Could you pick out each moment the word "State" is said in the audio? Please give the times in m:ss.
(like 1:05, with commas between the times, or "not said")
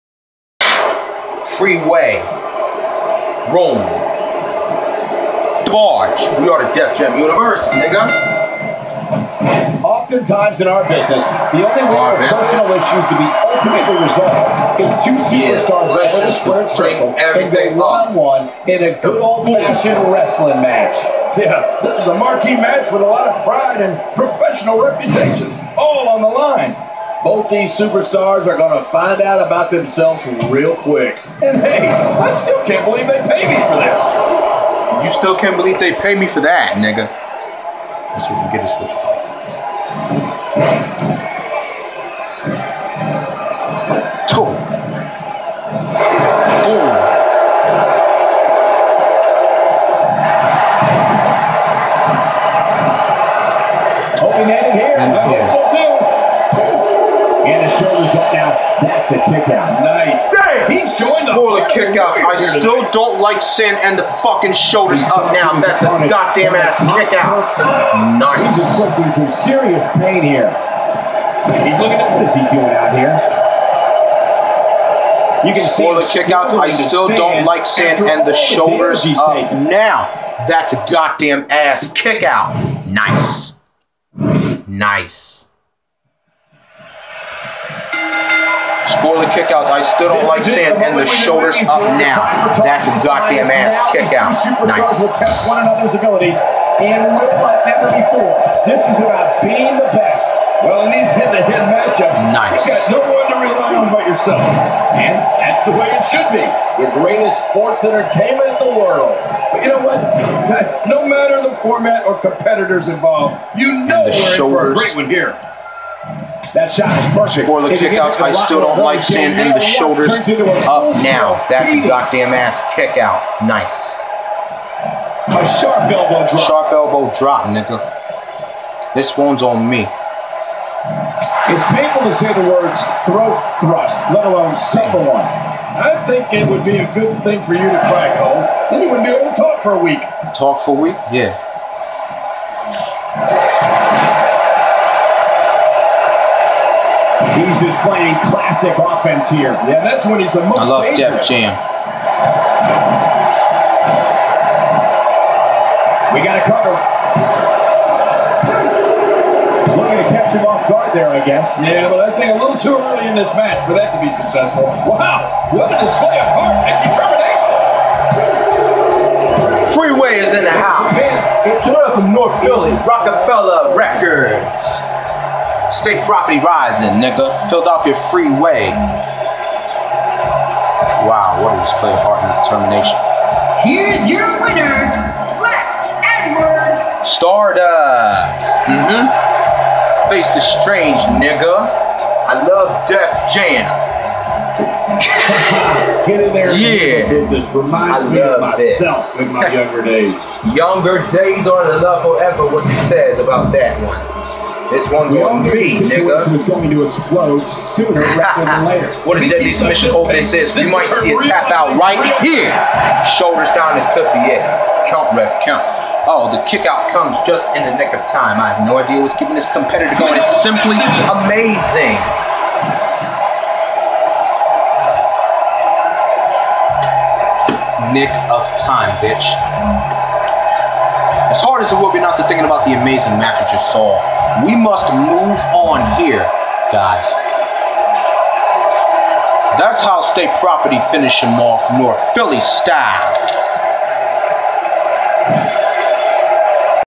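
2:55, 4:00.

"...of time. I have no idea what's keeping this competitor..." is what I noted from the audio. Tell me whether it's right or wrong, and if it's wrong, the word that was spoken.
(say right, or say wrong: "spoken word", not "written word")
right.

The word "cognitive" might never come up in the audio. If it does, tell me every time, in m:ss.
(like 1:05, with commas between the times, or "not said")
not said.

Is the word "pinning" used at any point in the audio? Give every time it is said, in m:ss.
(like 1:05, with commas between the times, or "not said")
not said.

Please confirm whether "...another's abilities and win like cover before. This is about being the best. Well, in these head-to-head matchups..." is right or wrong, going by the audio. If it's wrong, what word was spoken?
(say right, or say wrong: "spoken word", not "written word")
wrong: "never", not "cover".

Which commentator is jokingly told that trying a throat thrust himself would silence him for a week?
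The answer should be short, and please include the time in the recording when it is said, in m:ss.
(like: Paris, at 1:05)
Cole, at 2:18.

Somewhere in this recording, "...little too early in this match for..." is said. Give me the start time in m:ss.
2:42.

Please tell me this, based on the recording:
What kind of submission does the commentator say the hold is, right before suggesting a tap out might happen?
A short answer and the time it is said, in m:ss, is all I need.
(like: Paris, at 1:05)
Deadly Submission, at 3:29.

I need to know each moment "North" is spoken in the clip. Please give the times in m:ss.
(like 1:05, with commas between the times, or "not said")
2:52, 4:01.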